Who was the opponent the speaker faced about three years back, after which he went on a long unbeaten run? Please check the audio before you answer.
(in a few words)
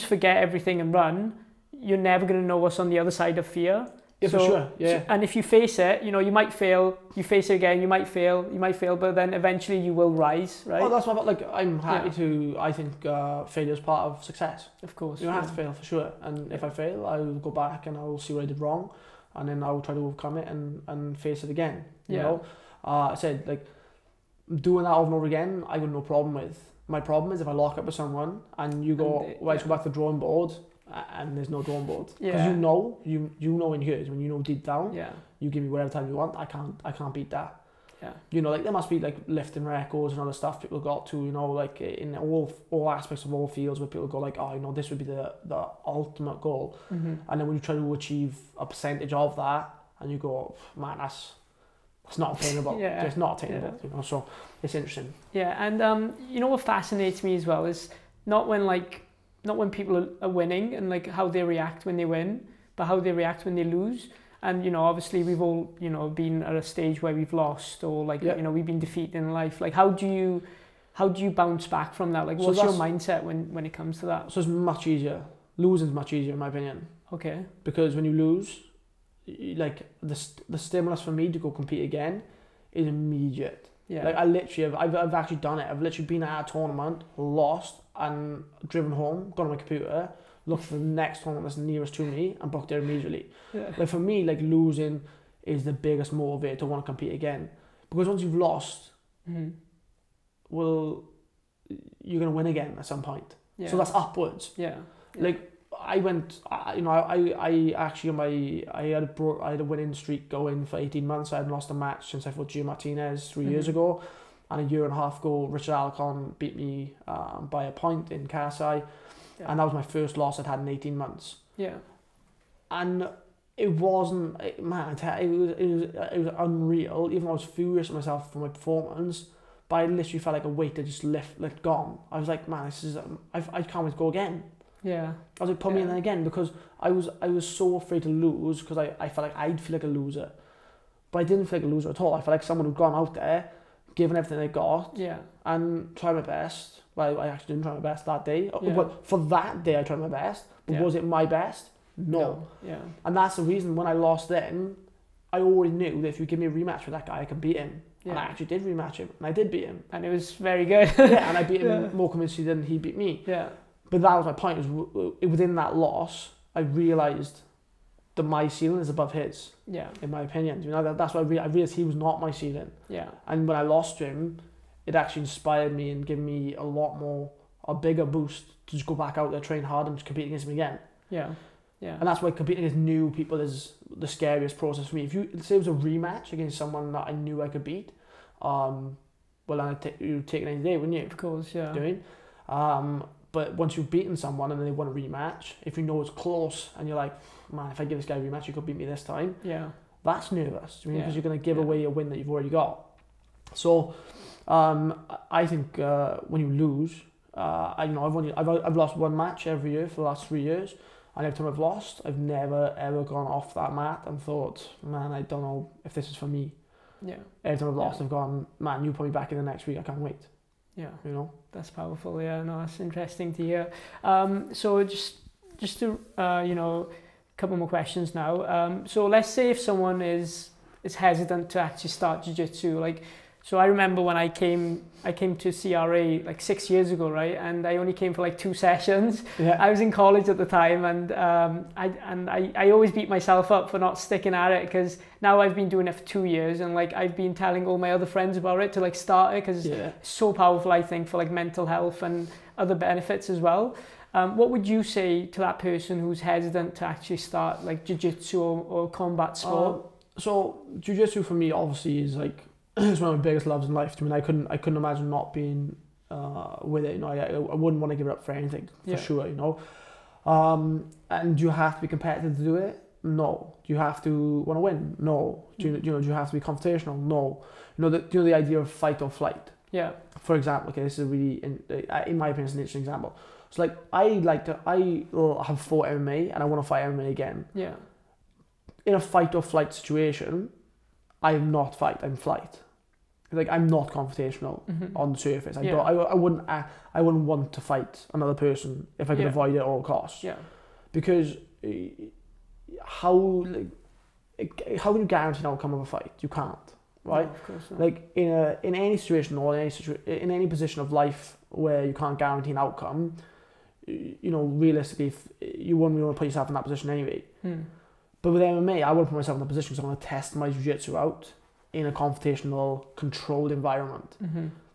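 Geo Martinez.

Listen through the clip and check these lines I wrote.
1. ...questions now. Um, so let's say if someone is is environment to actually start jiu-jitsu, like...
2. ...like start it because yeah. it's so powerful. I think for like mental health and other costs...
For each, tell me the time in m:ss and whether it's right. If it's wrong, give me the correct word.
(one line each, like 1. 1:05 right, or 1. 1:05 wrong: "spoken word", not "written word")
1. 3:47 wrong: "hesitant", not "environment"
2. 4:08 wrong: "benefits", not "costs".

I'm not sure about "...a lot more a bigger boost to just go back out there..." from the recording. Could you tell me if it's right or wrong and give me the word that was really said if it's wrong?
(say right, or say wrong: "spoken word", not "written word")
right.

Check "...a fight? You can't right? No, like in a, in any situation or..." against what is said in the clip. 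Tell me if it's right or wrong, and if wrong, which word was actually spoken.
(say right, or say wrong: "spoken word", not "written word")
right.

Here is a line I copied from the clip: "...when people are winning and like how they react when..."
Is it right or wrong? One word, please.
right.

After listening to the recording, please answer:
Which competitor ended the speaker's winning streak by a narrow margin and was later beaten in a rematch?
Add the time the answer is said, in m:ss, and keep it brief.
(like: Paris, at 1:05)
Richard Alcon, at 1:55.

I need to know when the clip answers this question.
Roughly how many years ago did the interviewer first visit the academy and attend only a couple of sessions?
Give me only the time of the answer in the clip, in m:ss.
3:56.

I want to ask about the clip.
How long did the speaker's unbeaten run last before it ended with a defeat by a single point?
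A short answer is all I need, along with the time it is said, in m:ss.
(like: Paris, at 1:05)
18 months, at 1:50.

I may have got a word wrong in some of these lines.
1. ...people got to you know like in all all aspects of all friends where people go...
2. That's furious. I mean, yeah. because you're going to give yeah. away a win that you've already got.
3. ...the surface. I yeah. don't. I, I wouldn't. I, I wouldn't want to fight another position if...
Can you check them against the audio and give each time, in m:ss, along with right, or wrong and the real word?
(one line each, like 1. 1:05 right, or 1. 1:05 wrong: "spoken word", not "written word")
1. 0:40 wrong: "fields", not "friends"
2. 3:20 wrong: "nervous", not "furious"
3. 4:55 wrong: "person", not "position".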